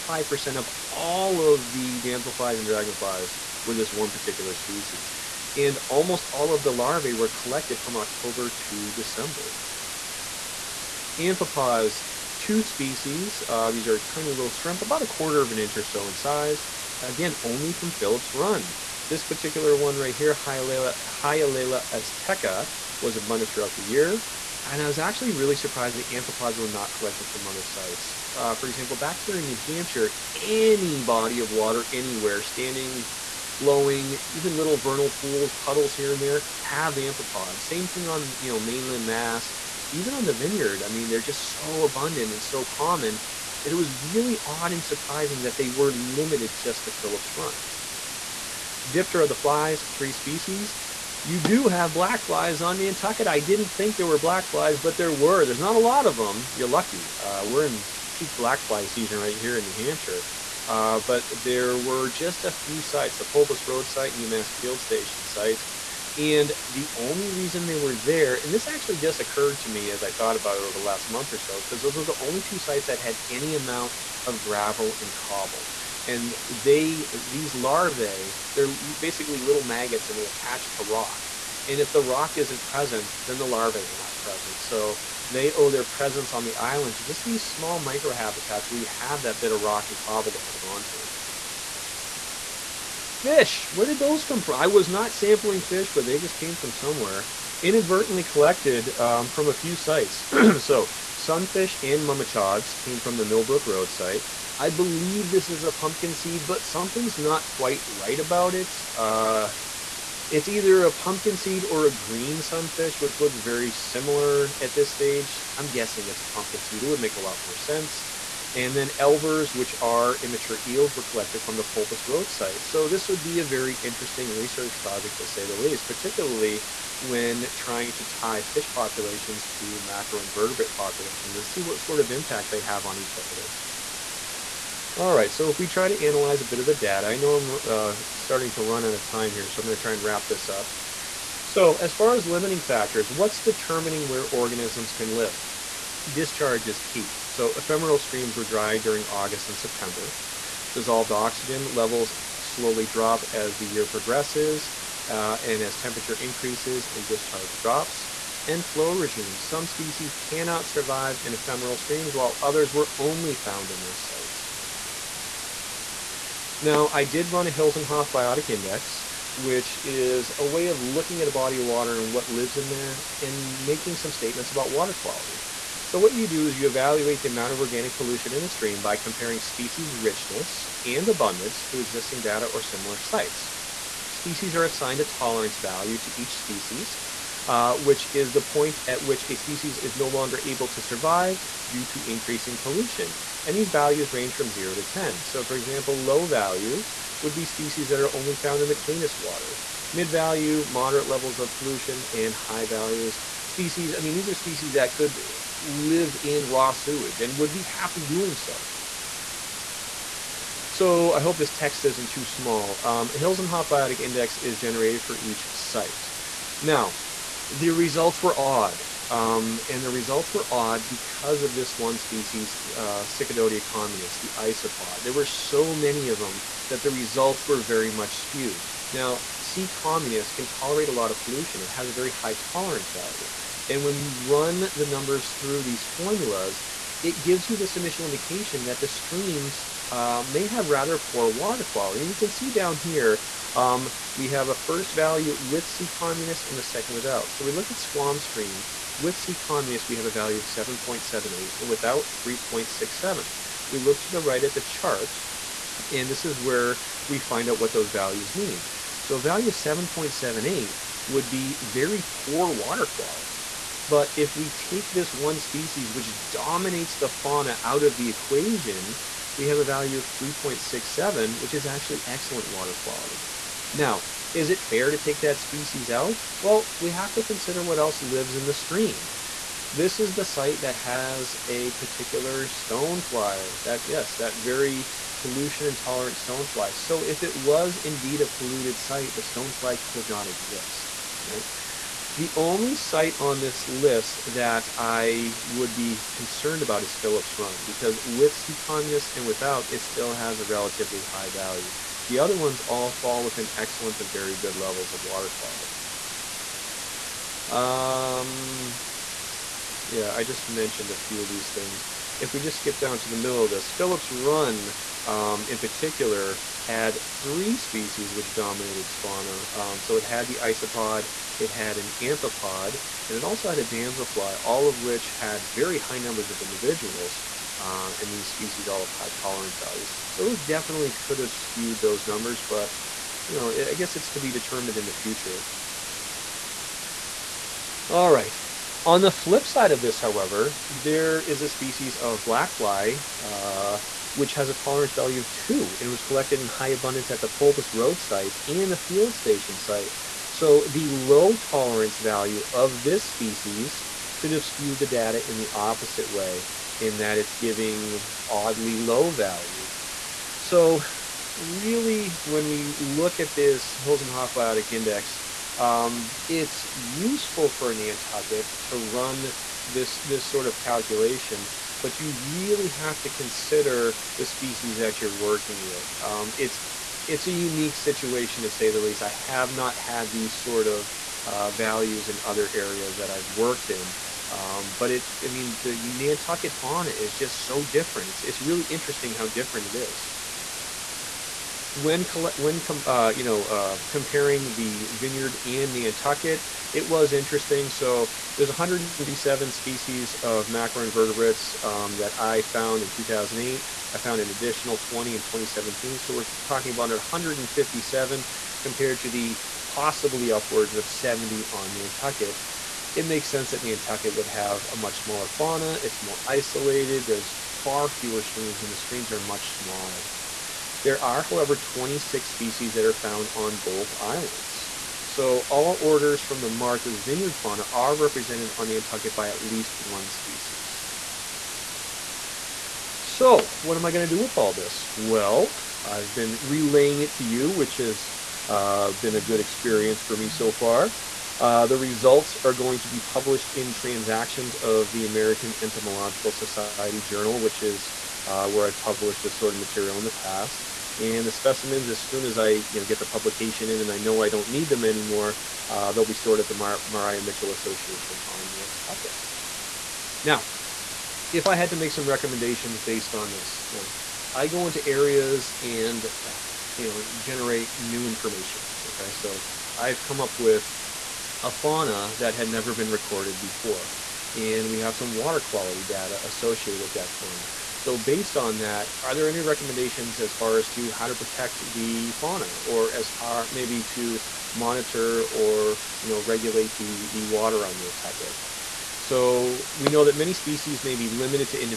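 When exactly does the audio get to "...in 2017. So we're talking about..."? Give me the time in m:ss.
6:45.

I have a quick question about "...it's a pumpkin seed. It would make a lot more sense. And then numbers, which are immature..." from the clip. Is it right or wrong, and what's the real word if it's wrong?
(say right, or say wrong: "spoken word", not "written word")
wrong: "elvers", not "numbers".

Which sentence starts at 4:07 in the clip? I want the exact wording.
So we look at Squam Stream, with C communis, we have a value of 7.78 and without 3.67.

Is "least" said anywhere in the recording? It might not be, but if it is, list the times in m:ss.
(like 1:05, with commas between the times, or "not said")
2:05, 6:18, 7:09.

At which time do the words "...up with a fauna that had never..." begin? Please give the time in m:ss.
7:50.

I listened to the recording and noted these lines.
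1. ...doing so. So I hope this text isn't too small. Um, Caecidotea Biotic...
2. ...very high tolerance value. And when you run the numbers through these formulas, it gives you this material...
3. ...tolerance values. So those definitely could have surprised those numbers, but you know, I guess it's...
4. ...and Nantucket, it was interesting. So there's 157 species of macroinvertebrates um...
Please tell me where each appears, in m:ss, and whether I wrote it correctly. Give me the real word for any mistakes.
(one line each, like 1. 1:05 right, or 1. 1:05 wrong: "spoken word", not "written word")
1. 3:28 wrong: "Hilsenhoff", not "Caecidotea"
2. 3:51 wrong: "initial", not "material"
3. 5:29 wrong: "skewed", not "surprised"
4. 6:35 right.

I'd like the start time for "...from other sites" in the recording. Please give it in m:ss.
0:27.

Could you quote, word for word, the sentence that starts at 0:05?
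And almost all of the larvae were collected from October to December.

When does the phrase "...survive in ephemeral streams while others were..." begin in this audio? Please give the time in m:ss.
2:40.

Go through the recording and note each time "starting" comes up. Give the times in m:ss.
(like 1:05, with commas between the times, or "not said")
2:18.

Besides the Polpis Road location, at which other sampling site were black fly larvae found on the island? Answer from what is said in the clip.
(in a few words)
UMass Field Station.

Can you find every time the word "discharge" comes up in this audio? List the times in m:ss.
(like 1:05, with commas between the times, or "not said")
2:26, 2:37.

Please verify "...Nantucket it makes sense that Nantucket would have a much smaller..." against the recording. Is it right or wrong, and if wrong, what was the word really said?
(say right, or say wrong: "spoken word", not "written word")
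right.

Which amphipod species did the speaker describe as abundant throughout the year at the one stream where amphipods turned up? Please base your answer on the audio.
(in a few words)
Hyalella azteca.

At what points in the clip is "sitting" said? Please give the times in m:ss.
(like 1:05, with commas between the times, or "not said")
not said.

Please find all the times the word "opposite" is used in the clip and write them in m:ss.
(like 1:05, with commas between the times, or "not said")
5:55.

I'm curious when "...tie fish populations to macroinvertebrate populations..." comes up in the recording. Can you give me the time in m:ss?
2:08.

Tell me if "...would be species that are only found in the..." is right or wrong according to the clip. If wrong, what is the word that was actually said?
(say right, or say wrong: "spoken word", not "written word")
right.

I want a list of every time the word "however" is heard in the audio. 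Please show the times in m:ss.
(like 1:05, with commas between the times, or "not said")
5:39, 7:01.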